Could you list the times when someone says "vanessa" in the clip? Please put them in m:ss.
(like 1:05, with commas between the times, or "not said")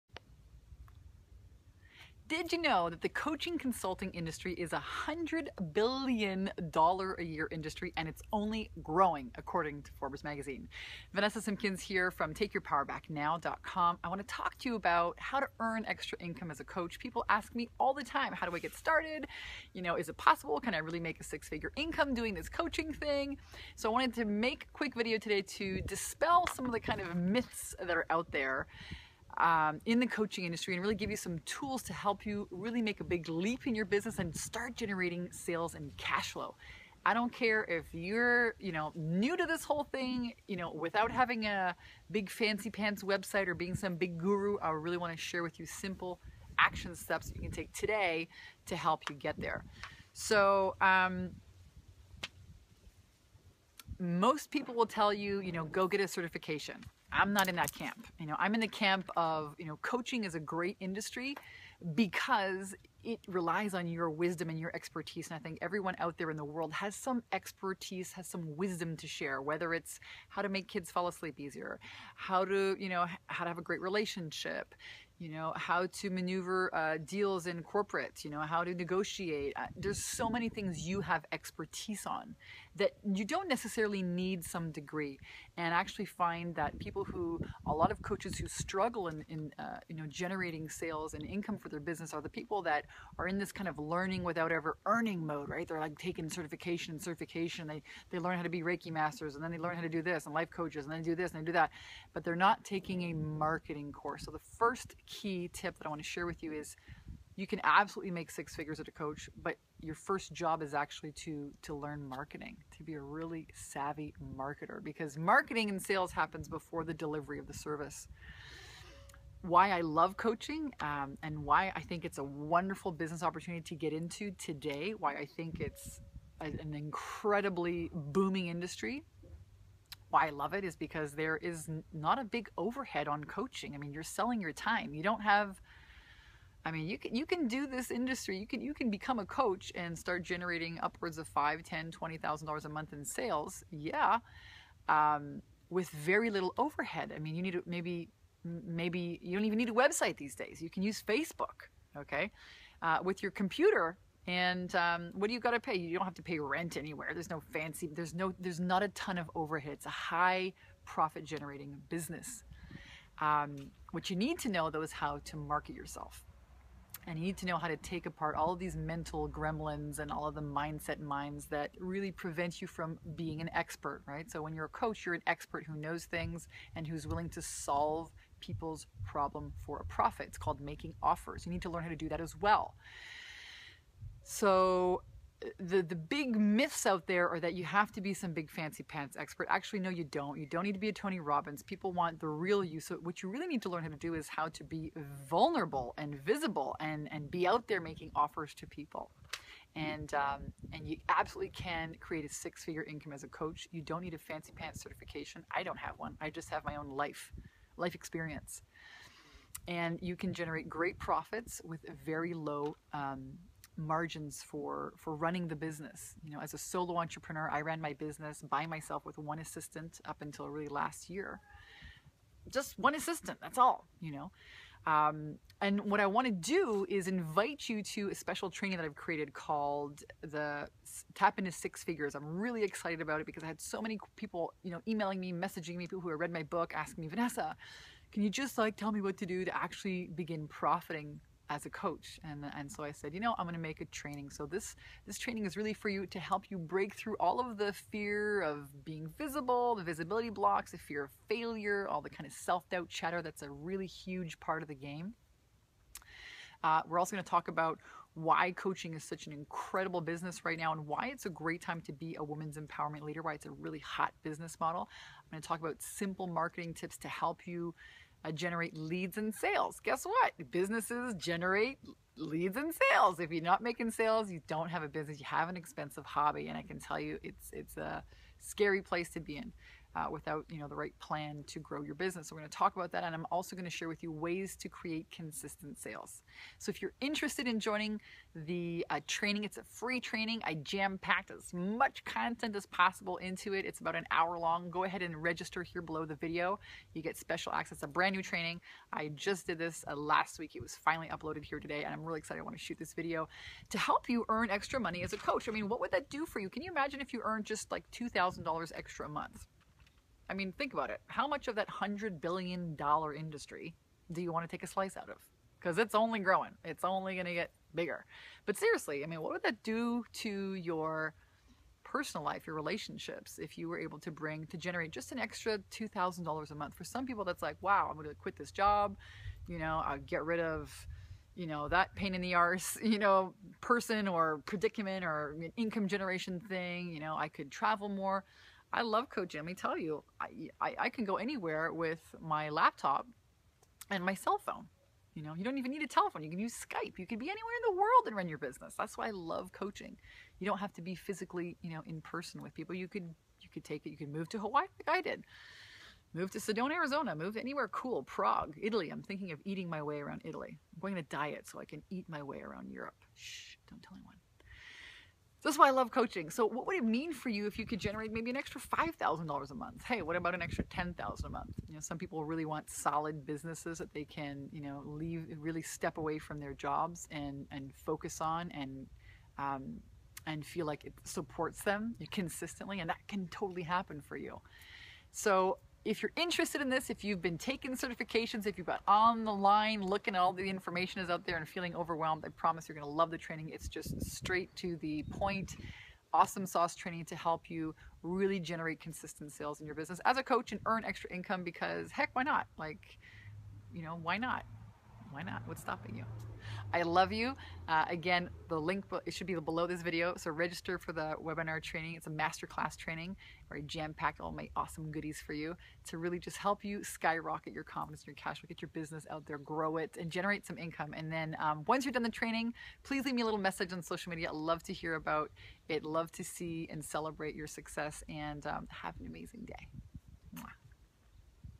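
0:11, 3:57.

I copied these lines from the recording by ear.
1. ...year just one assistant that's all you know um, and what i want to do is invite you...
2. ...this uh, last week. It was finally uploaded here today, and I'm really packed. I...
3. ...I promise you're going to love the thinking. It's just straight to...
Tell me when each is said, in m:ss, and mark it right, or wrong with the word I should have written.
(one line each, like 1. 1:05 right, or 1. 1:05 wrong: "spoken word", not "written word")
1. 3:41 right
2. 4:59 wrong: "excited", not "packed"
3. 6:32 wrong: "training", not "thinking".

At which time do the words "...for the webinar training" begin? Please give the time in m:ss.
6:50.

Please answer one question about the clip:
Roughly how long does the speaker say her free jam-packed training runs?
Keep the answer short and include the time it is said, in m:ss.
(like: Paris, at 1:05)
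1 hour, at 4:53.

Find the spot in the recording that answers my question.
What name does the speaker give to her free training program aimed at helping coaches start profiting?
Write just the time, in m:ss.
3:51.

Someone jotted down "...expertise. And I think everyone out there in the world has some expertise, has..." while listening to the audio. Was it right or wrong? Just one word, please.
right.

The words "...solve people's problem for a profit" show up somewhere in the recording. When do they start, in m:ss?
2:57.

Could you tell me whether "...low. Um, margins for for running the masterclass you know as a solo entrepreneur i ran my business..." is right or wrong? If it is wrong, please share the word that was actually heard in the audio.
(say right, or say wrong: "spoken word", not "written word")
wrong: "business", not "masterclass".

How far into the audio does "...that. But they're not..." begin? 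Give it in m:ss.
1:41.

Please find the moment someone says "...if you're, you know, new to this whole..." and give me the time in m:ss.
0:37.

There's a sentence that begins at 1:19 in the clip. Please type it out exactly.
Uh, there's so many things you have expertise on that you don't necessarily need some degree.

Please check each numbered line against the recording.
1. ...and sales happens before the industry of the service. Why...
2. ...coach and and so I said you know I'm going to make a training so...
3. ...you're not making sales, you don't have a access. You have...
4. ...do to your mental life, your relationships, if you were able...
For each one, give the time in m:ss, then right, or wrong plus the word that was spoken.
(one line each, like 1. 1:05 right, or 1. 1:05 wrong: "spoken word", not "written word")
1. 1:55 wrong: "delivery", not "industry"
2. 4:01 right
3. 4:33 wrong: "business", not "access"
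4. 5:19 wrong: "personal", not "mental".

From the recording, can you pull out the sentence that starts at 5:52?
You could you could take it.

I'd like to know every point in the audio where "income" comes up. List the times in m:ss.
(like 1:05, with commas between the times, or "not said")
0:16, 0:21, 1:31, 3:22, 5:35, 6:41, 7:00.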